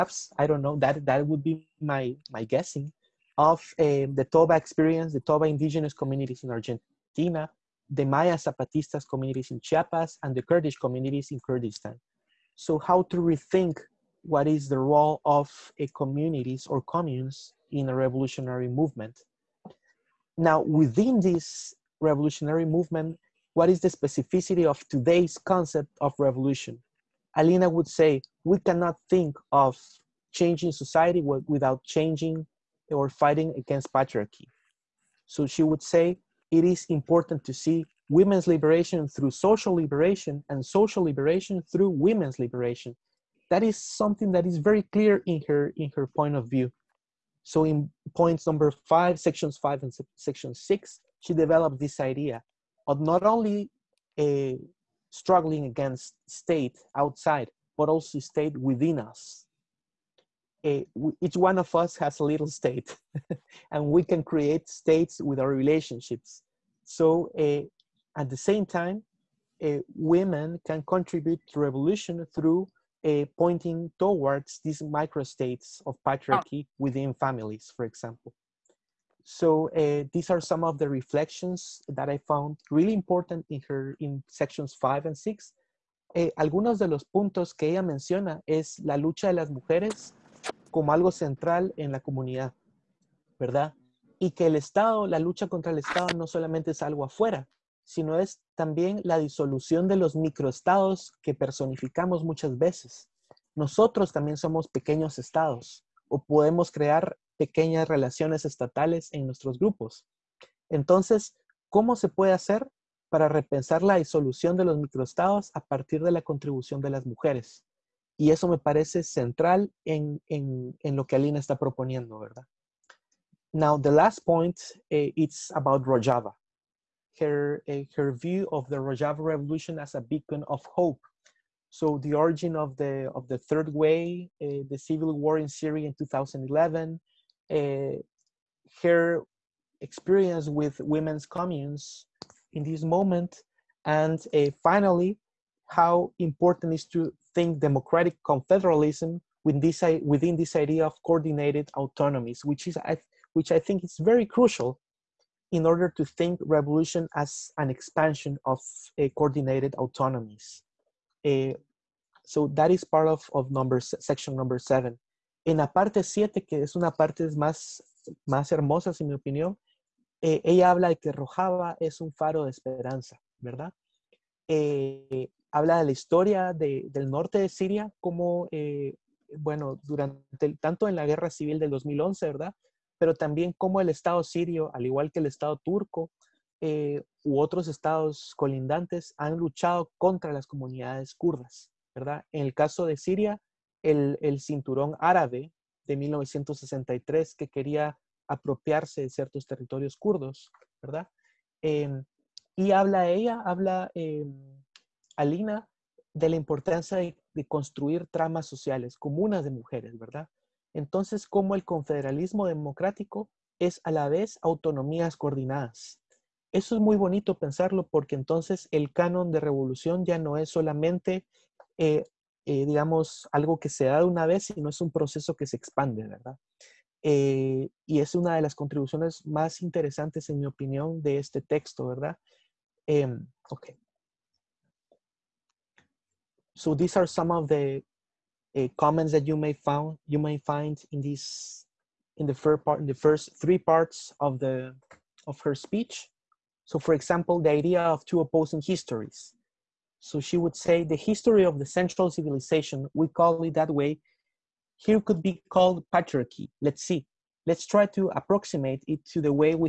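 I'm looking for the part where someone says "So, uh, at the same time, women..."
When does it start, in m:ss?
1:06.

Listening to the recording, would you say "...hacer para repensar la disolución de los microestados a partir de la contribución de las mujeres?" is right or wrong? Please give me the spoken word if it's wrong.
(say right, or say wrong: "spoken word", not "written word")
right.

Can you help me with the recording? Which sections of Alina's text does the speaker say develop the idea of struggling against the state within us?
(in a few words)
5 and 6.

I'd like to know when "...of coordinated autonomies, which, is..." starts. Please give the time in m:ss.
2:30.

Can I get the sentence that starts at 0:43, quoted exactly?
That is something that is very clear in her, in her point of view.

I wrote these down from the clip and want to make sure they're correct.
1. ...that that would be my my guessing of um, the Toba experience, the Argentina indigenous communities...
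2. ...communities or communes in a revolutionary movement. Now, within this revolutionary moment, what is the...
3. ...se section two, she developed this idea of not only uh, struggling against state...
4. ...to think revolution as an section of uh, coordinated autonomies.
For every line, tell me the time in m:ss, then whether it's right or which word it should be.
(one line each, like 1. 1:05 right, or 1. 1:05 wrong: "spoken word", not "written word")
1. 0:00 wrong: "Toba", not "Argentina"
2. 0:15 wrong: "movement", not "moment"
3. 0:49 wrong: "six", not "two"
4. 2:35 wrong: "expansion", not "section".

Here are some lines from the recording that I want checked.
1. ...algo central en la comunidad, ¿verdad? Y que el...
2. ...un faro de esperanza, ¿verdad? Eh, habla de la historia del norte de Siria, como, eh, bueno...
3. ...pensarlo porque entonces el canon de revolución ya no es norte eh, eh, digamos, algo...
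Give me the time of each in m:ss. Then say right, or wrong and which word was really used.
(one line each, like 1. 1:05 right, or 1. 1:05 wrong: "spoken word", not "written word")
1. 1:30 right
2. 2:51 right
3. 3:37 wrong: "solamente", not "norte".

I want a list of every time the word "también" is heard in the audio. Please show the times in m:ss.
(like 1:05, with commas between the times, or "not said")
1:38, 1:44, 3:03.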